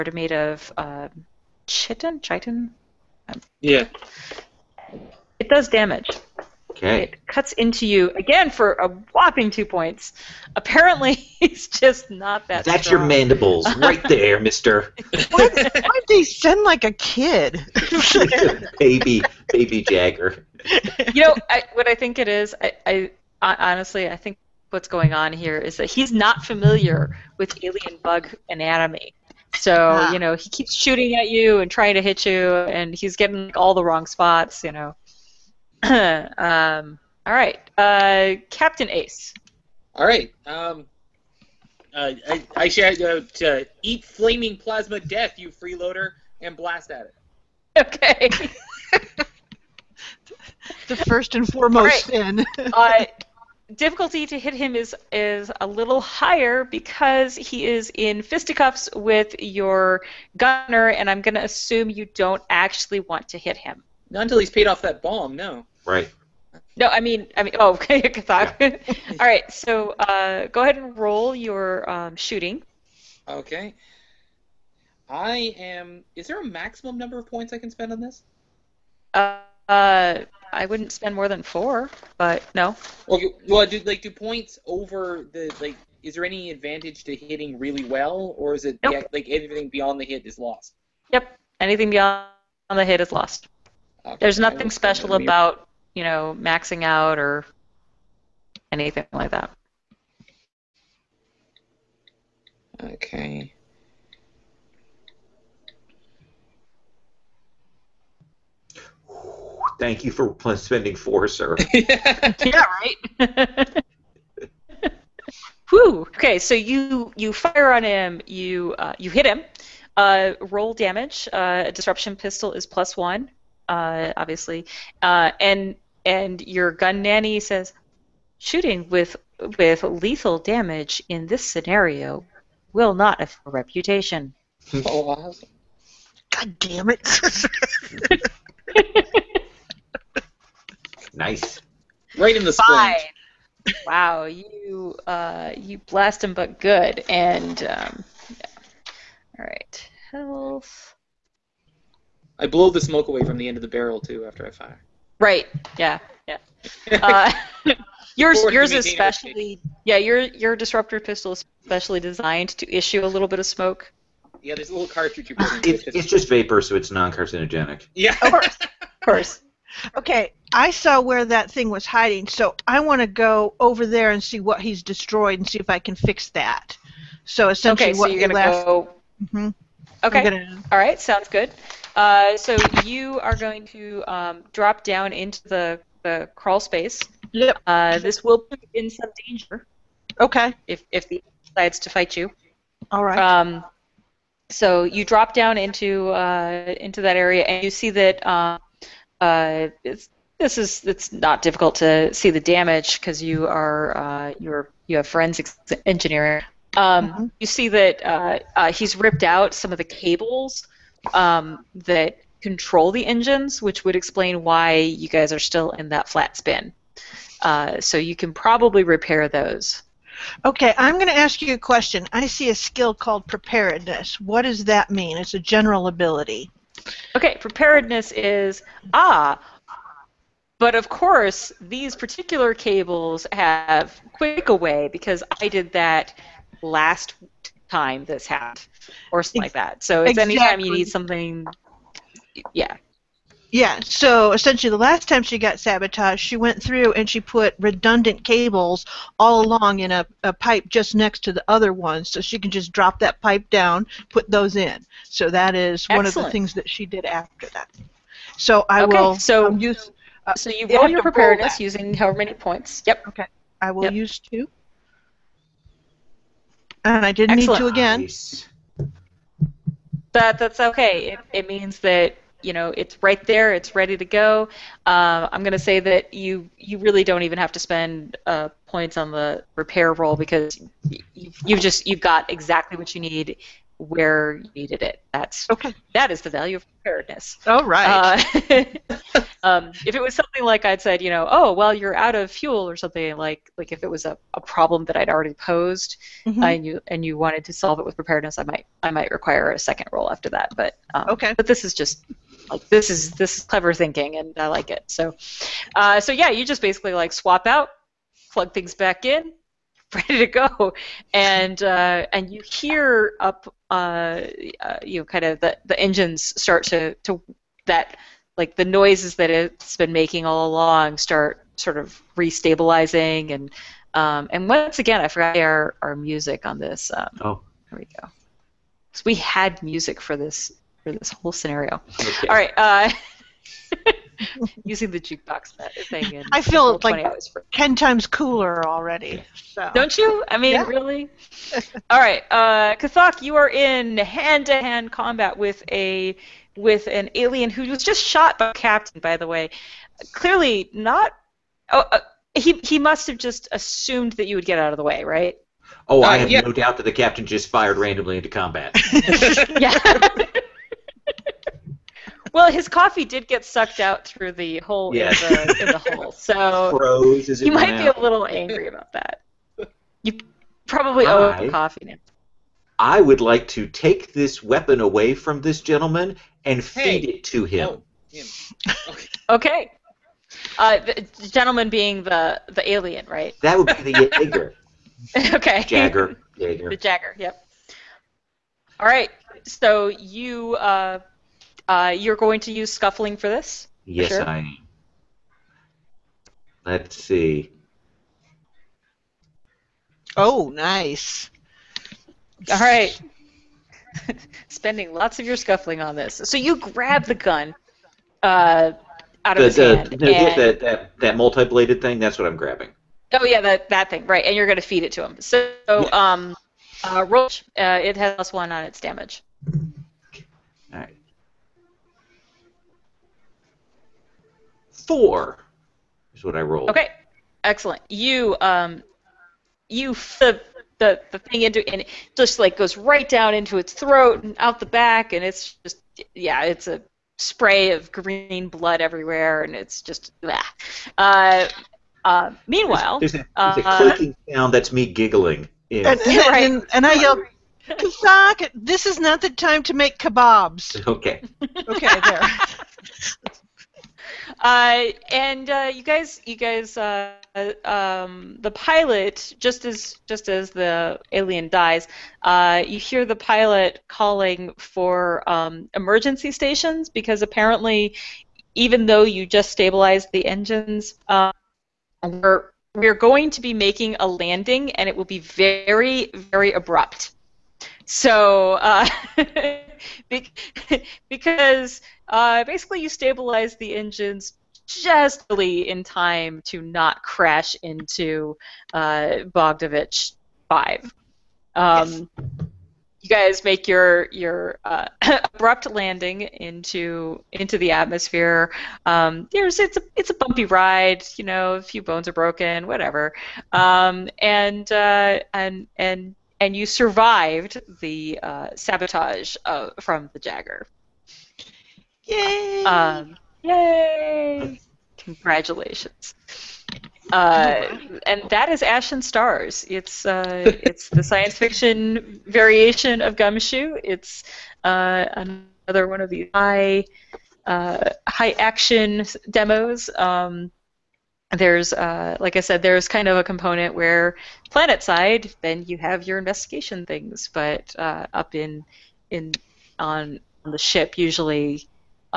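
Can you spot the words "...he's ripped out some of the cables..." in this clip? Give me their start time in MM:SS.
03:28.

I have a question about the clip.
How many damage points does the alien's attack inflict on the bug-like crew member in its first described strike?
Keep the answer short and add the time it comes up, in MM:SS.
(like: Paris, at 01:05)
2, at 00:09.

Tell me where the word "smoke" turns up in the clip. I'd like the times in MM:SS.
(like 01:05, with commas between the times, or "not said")
02:32, 02:43.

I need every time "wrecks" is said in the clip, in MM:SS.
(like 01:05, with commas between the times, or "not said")
not said.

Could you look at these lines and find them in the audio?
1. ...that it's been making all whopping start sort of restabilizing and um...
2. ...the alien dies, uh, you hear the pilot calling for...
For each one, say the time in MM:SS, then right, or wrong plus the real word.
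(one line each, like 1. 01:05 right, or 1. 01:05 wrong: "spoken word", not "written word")
1. 05:19 wrong: "along", not "whopping"
2. 07:40 right.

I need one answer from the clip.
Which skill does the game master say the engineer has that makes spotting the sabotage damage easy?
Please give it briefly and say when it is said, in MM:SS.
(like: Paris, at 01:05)
Forensics engineering, at 03:25.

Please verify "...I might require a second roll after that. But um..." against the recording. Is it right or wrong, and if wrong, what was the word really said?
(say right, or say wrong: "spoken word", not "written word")
right.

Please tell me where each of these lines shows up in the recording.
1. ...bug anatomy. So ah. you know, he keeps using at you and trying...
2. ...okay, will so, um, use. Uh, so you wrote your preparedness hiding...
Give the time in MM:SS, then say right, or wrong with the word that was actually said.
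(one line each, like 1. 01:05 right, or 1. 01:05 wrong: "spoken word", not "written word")
1. 00:28 wrong: "shooting", not "using"
2. 04:18 wrong: "using", not "hiding".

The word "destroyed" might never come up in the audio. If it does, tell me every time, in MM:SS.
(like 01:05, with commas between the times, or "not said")
02:54.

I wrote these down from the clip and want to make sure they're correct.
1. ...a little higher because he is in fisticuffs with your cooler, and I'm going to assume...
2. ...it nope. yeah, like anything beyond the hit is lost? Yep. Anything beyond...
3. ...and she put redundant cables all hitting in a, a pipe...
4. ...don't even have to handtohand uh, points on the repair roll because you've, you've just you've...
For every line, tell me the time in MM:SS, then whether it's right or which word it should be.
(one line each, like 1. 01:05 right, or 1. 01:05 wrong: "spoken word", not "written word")
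1. 00:55 wrong: "gunner", not "cooler"
2. 01:28 right
3. 04:06 wrong: "along", not "hitting"
4. 04:37 wrong: "spend", not "handtohand".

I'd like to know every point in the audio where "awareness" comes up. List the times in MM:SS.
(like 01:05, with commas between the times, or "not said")
not said.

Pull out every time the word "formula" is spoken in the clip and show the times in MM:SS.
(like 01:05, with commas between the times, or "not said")
not said.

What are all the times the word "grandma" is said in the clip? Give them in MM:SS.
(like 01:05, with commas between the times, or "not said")
not said.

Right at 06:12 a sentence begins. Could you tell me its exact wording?
I would like to take this weapon away from this gentleman and hey, feed it to oh, him.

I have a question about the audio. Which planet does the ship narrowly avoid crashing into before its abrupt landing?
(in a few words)
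Bogdanovich 5.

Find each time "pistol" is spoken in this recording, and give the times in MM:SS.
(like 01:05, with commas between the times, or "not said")
02:02, 02:40.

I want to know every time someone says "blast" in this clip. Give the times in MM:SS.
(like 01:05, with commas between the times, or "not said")
00:46, 02:25.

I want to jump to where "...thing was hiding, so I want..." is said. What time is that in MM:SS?
02:51.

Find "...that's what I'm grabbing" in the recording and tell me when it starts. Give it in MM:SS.
06:51.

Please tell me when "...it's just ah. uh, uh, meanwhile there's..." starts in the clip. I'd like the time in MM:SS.
07:19.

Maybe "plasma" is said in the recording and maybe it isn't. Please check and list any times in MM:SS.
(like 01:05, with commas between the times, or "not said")
00:44.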